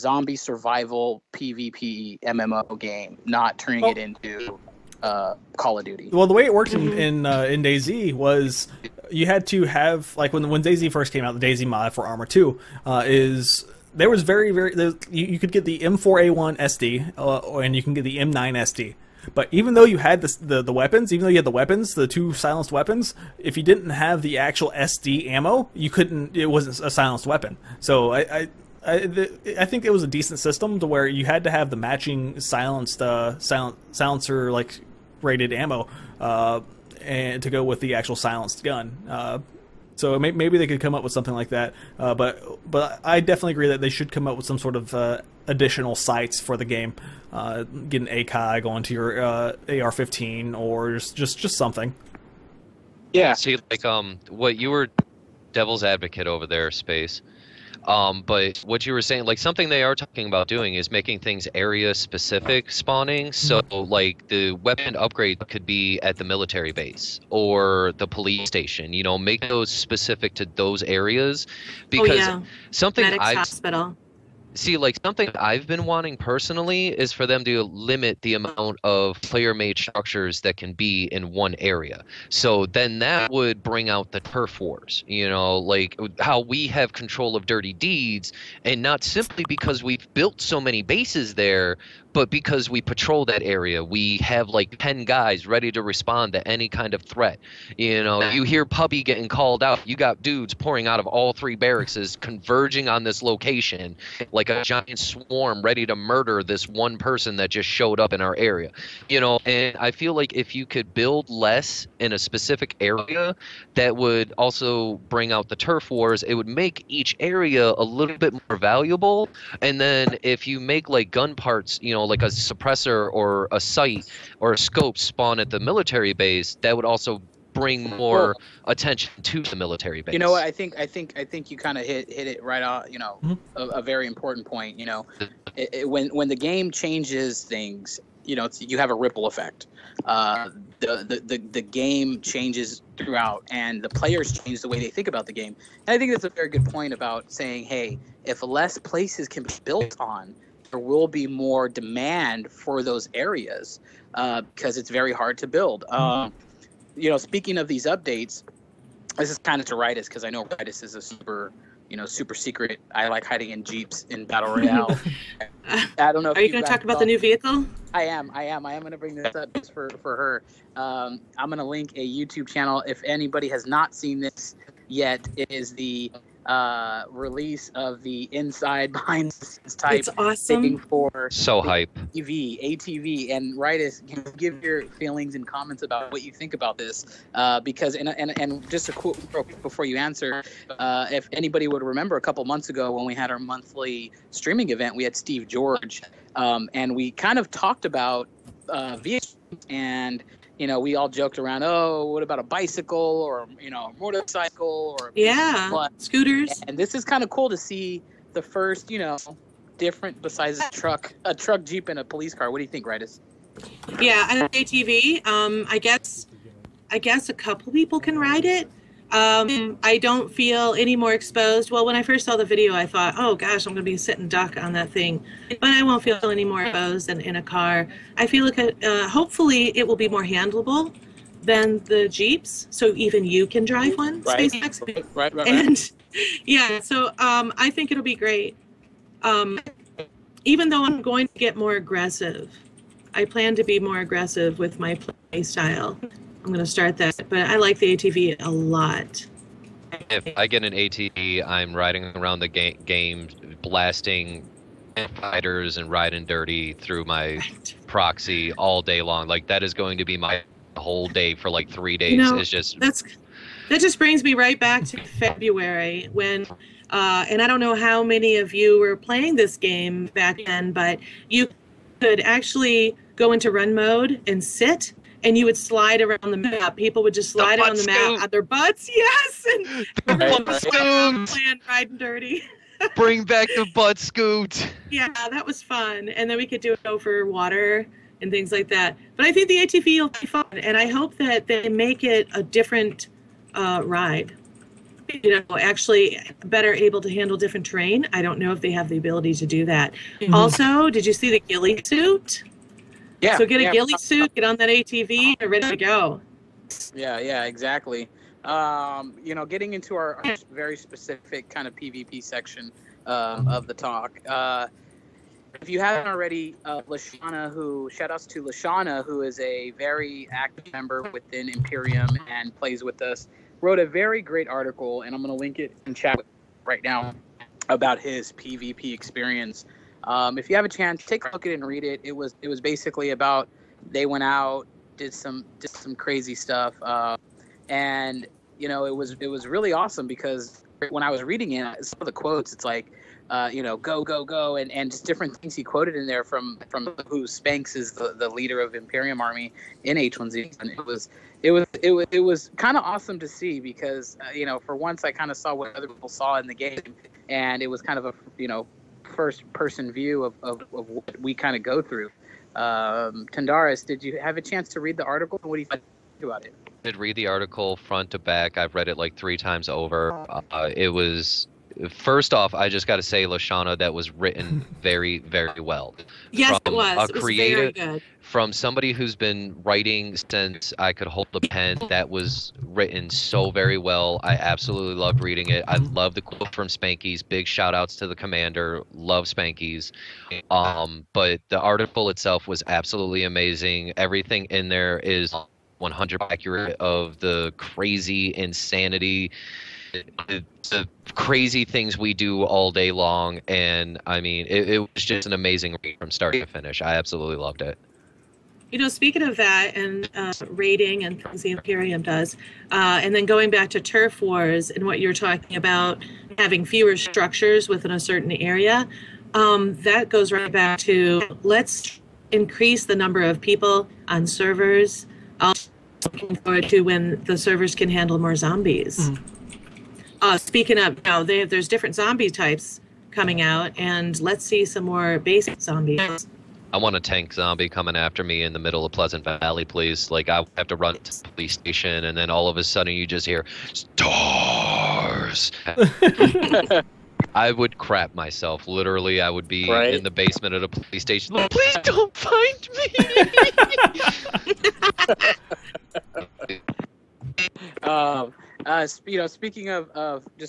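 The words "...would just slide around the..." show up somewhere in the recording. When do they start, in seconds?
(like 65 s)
277 s.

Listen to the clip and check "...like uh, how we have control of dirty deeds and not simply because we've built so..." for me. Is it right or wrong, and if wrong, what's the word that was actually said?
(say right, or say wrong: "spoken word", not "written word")
right.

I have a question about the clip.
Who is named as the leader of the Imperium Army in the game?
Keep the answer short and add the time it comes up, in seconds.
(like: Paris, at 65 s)
Spanx, at 347 s.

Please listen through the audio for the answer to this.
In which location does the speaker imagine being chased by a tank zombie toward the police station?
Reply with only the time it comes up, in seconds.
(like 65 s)
438 s.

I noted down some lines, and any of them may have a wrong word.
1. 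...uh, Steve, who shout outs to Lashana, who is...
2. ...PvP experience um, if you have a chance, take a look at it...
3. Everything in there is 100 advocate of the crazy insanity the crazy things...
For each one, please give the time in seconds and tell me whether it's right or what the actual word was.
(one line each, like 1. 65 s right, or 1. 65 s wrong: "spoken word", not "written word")
1. 316 s wrong: "Lashana", not "Steve"
2. 328 s right
3. 393 s wrong: "accurate", not "advocate".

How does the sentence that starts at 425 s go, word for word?
I'm uh, looking forward to when the servers can handle more zombies.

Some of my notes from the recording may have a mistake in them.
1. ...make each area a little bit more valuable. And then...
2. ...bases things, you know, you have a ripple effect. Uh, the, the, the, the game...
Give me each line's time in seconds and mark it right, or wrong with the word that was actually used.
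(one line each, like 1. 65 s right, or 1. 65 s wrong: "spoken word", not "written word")
1. 116 s right
2. 136 s wrong: "changes", not "bases".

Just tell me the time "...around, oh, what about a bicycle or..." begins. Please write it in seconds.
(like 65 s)
201 s.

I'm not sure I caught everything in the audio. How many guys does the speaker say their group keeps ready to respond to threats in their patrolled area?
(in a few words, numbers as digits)
10.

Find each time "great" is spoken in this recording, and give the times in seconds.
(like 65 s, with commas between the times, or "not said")
238 s, 324 s.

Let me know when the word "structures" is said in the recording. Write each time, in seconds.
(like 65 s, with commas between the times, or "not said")
79 s, 416 s.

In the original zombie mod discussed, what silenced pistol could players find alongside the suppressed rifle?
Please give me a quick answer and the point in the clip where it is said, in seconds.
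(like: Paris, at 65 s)
M9 SD, at 18 s.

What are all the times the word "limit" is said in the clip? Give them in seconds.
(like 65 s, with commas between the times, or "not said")
77 s.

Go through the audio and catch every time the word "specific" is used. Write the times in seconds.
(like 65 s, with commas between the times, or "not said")
61 s, 69 s, 112 s, 310 s.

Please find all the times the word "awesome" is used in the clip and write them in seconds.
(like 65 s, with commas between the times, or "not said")
180 s, 339 s, 352 s.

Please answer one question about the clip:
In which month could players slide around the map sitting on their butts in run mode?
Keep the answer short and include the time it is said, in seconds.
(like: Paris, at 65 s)
February, at 265 s.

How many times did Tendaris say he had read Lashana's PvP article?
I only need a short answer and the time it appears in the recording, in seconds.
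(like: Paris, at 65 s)
3, at 369 s.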